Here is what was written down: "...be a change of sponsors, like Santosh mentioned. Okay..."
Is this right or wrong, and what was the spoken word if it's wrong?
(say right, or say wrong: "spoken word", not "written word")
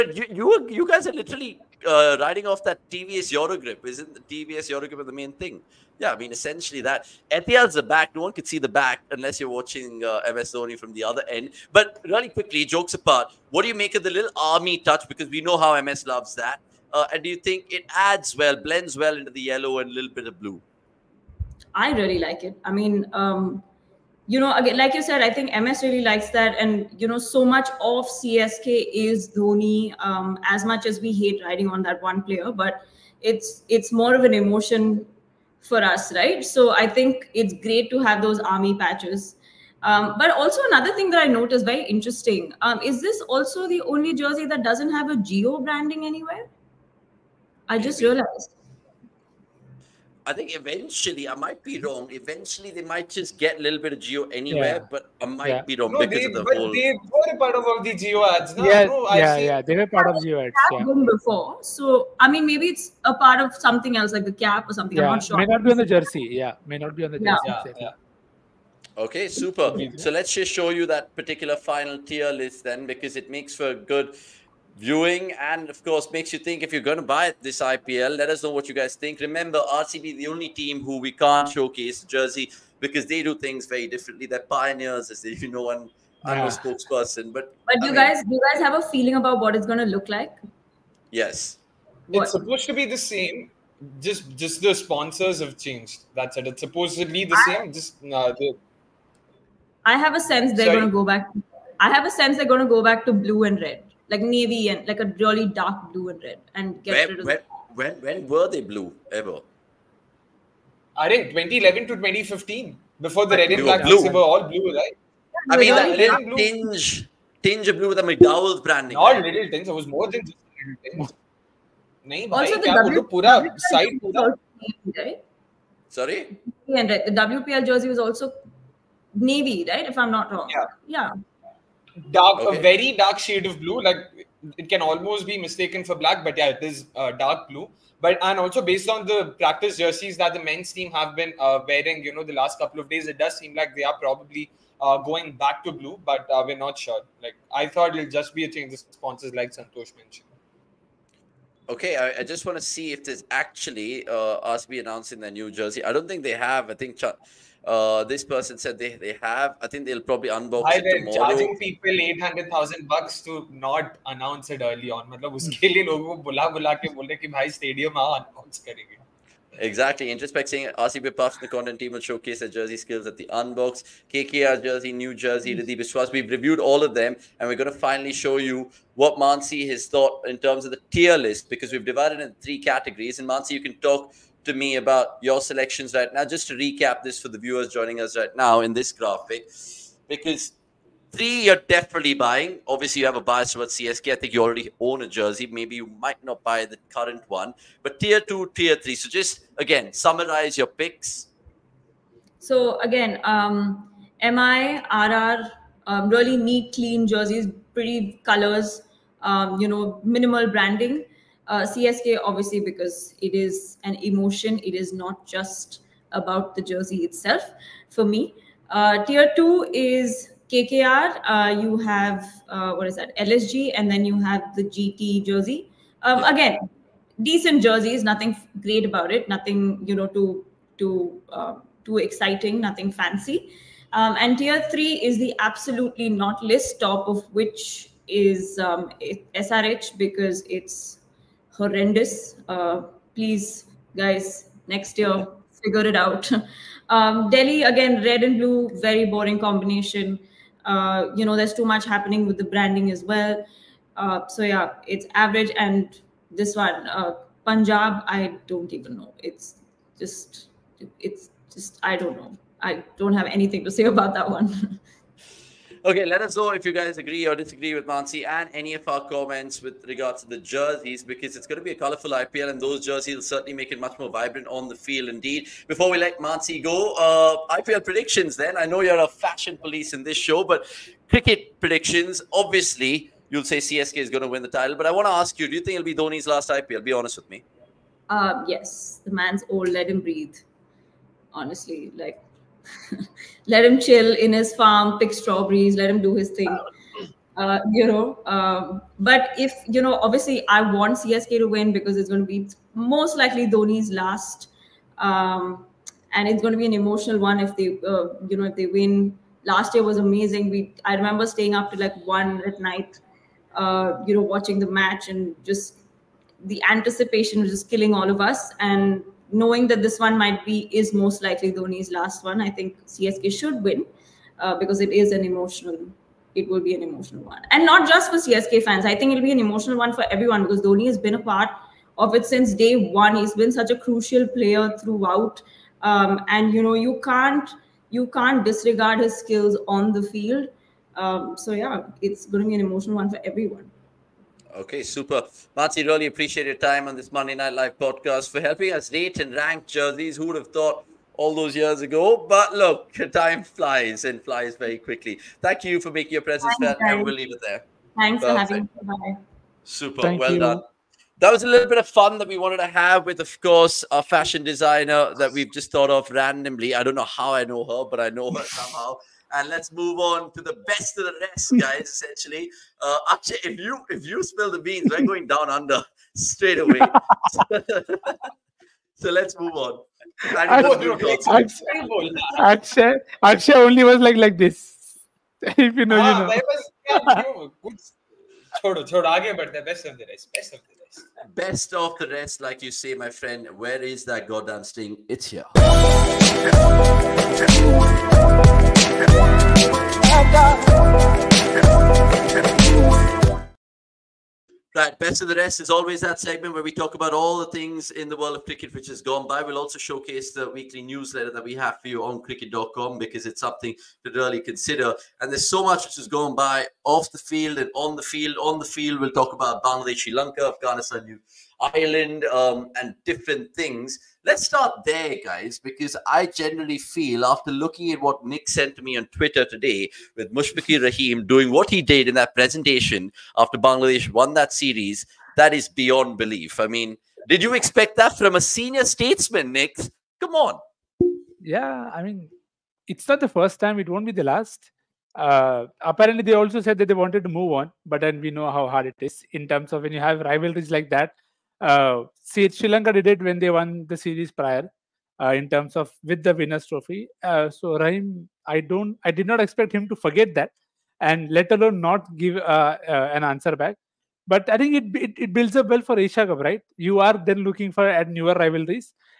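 right.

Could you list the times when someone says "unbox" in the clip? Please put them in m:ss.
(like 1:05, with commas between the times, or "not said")
2:40, 2:53.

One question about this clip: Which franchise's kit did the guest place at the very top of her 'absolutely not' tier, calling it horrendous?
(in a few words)
SRH.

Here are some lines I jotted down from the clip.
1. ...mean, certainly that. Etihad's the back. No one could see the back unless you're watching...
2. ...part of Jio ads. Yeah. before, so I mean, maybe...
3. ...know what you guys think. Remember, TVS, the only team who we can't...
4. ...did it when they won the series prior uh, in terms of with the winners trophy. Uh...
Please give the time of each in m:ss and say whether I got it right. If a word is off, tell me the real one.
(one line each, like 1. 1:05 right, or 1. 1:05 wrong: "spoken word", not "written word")
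1. 0:06 wrong: "essentially", not "certainly"
2. 0:59 right
3. 1:18 wrong: "RCB", not "TVS"
4. 7:32 right.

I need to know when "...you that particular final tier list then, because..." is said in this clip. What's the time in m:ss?
1:10.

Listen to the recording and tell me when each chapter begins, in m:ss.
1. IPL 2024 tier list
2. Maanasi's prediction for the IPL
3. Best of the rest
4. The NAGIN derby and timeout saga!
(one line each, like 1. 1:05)
1. 3:07
2. 4:41
3. 6:12
4. 7:13.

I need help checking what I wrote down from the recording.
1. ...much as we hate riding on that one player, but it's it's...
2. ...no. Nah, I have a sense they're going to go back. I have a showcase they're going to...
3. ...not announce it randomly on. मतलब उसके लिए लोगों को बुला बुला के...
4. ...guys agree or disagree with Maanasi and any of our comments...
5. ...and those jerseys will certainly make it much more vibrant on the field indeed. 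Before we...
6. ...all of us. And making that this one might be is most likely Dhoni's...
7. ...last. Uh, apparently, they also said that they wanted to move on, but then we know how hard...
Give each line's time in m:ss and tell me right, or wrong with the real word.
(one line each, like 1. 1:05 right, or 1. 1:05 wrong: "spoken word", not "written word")
1. 0:30 right
2. 1:38 wrong: "sense", not "showcase"
3. 2:43 wrong: "early", not "randomly"
4. 4:26 right
5. 4:32 right
6. 5:17 wrong: "knowing", not "making"
7. 7:24 right.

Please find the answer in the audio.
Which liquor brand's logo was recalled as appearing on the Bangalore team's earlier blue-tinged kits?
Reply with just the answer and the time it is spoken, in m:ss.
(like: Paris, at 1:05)
McDowell's, at 1:58.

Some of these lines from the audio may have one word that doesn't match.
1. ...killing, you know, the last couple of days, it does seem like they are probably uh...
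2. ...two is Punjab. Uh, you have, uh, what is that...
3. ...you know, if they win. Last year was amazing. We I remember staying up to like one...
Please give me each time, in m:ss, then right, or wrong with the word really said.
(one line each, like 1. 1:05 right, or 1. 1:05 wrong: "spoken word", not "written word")
1. 2:21 wrong: "wearing", not "killing"
2. 3:39 wrong: "KKR", not "Punjab"
3. 5:08 right.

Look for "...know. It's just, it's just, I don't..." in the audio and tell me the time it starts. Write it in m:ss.
4:18.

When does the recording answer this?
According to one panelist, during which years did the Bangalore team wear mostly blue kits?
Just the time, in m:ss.
1:51.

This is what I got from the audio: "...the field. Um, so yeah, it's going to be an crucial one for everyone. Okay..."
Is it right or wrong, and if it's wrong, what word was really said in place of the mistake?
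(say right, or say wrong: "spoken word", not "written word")
wrong: "emotional", not "crucial".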